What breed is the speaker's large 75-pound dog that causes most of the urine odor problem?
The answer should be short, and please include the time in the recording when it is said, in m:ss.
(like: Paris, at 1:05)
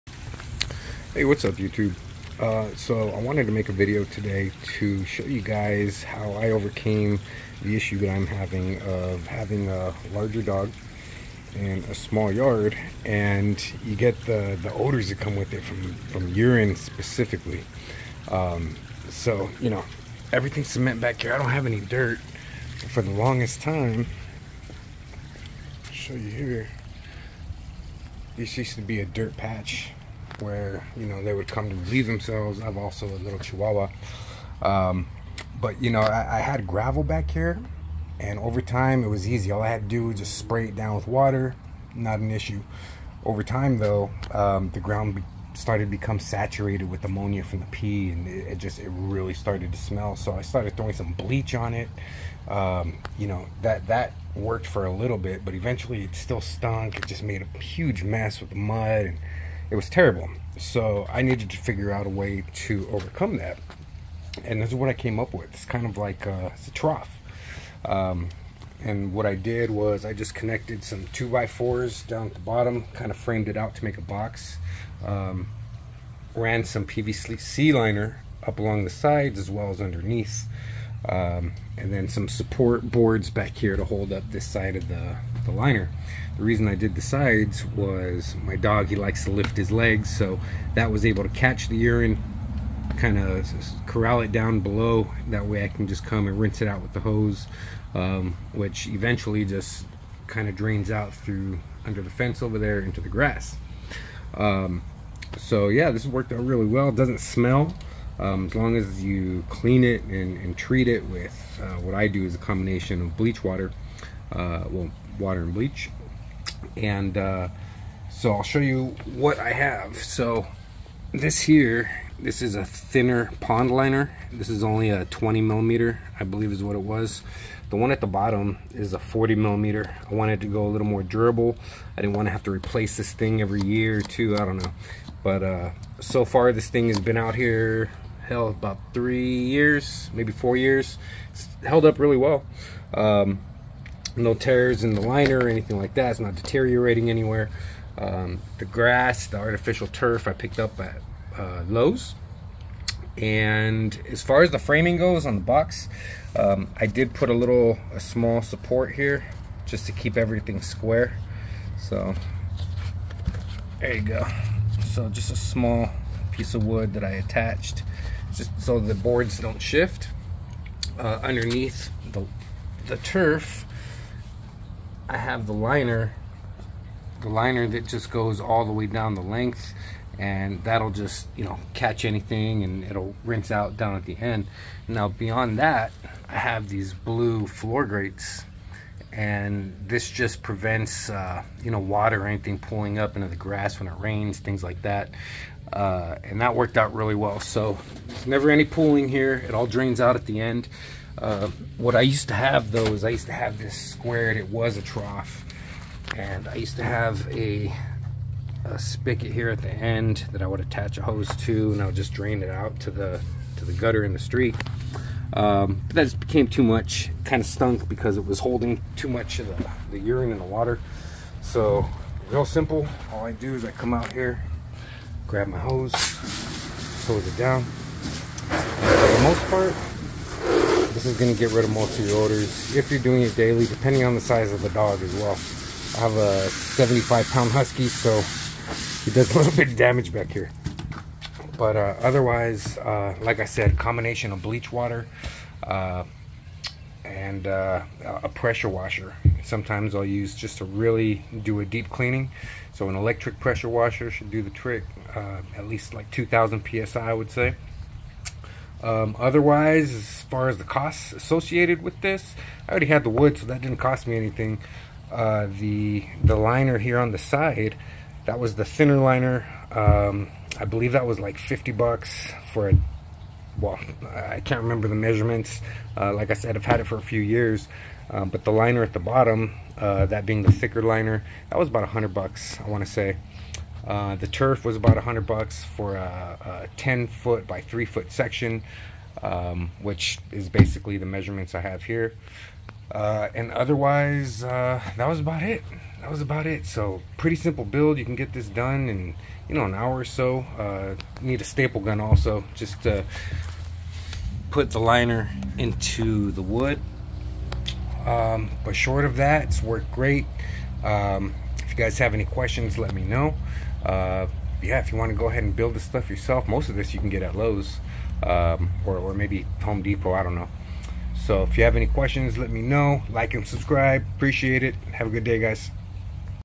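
Husky, at 3:57.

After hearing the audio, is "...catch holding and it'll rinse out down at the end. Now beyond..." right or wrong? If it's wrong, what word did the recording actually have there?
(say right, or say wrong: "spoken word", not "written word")
wrong: "anything", not "holding".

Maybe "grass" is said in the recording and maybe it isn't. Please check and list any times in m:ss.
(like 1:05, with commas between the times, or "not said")
1:43, 2:28, 3:13.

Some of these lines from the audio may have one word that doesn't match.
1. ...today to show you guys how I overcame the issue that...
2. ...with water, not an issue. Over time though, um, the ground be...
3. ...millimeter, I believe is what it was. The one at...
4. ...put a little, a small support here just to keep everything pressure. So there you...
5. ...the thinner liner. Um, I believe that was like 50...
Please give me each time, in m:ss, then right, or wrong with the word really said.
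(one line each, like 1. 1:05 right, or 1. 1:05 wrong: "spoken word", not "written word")
1. 0:04 right
2. 0:40 right
3. 2:05 right
4. 2:37 wrong: "square", not "pressure"
5. 4:28 right.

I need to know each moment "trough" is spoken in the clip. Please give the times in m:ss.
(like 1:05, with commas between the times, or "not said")
1:06, 3:24.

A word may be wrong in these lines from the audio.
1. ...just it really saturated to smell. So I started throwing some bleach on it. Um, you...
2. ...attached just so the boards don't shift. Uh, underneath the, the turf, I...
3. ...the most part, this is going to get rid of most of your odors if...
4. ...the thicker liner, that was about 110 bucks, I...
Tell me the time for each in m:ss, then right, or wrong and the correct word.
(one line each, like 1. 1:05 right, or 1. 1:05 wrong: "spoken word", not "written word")
1. 0:48 wrong: "started", not "saturated"
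2. 2:47 right
3. 3:49 wrong: "orders", not "odors"
4. 4:40 wrong: "100", not "110".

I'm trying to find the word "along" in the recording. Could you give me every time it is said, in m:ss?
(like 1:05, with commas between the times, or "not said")
1:18.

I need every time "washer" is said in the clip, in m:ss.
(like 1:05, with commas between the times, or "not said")
4:08, 4:13.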